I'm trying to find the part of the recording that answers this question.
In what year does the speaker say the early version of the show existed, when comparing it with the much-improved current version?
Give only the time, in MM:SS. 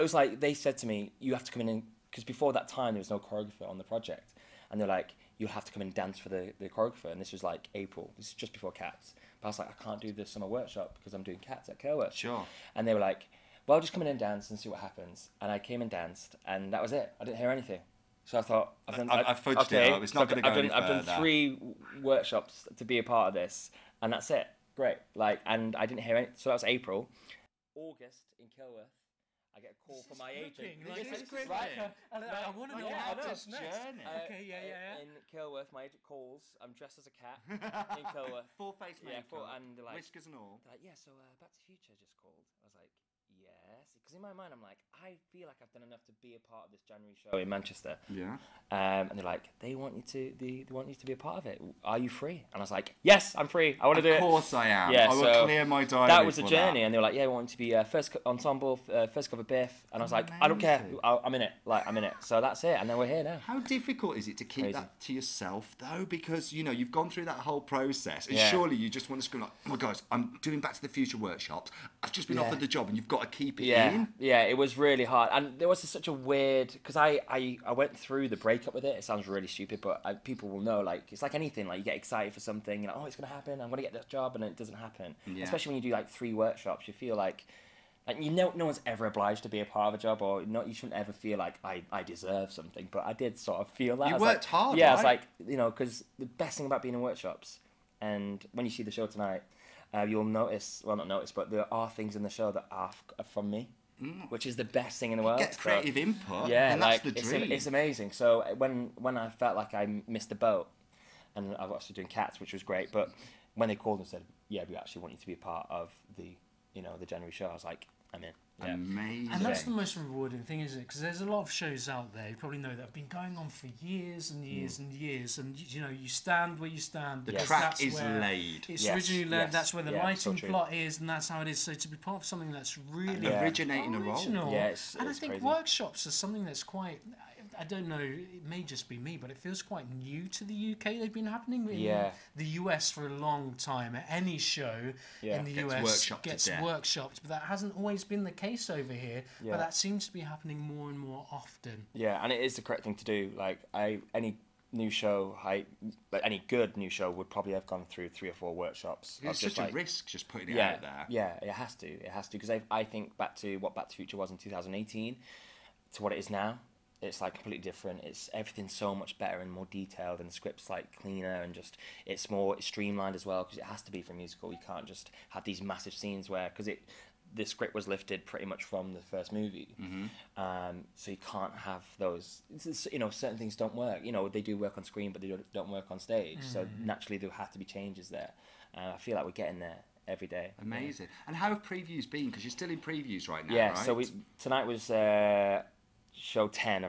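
02:44.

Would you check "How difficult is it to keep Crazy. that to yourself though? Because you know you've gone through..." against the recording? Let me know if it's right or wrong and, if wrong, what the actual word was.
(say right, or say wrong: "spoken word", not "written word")
right.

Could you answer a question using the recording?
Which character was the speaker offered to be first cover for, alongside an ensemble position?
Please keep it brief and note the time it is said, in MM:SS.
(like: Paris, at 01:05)
Biff, at 00:59.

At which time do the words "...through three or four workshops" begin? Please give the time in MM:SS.
02:37.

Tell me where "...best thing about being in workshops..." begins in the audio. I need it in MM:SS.
01:36.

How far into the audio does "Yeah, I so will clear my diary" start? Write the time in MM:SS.
00:54.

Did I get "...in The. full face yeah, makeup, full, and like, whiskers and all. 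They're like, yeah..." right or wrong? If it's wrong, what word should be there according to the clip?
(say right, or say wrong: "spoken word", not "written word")
wrong: "Kilworth", not "The".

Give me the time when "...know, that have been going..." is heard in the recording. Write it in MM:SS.
02:02.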